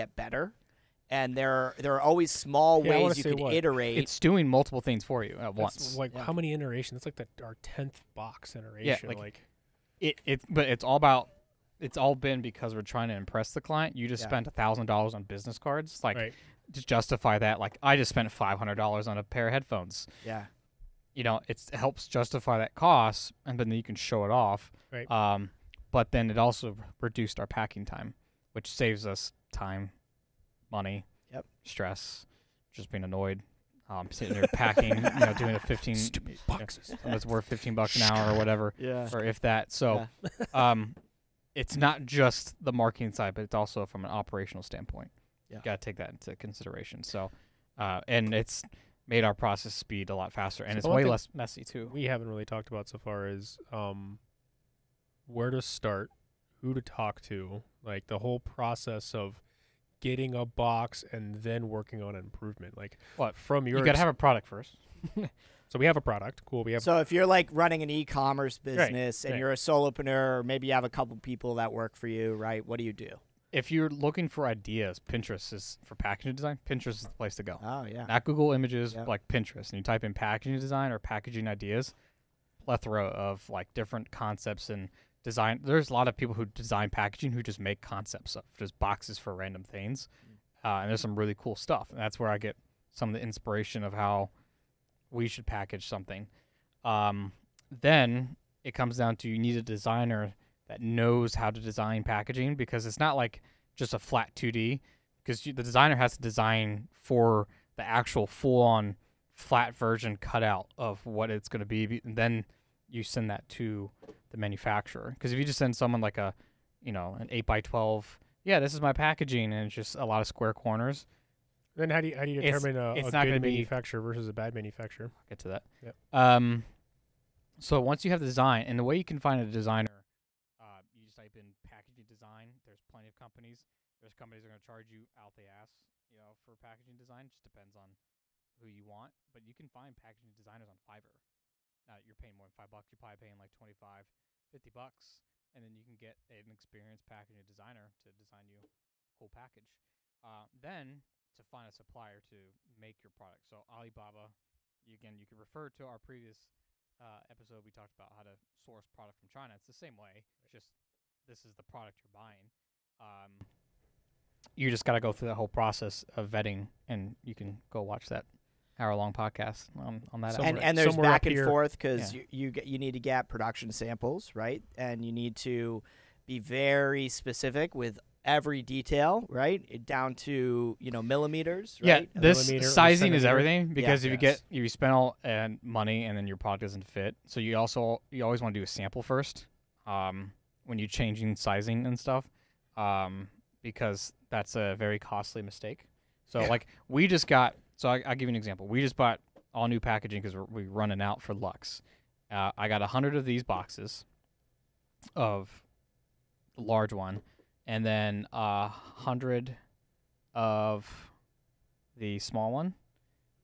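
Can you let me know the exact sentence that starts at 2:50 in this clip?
And, and, there's back and here.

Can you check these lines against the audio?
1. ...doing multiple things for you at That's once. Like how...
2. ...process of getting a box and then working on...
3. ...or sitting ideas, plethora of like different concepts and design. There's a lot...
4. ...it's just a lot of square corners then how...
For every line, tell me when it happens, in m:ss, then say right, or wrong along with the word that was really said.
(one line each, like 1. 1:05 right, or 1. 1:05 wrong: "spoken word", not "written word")
1. 0:04 right
2. 0:58 right
3. 1:20 wrong: "packaging", not "sitting"
4. 1:59 right.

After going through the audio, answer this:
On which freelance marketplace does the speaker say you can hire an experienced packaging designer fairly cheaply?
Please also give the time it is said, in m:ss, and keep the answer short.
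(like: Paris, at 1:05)
Fiverr, at 2:20.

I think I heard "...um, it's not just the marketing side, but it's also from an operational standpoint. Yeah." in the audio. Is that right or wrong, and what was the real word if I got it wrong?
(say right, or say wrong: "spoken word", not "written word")
right.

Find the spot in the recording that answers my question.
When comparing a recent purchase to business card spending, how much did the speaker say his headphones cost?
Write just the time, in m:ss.
0:18.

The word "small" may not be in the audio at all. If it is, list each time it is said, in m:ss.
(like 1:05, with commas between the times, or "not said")
0:02, 3:32.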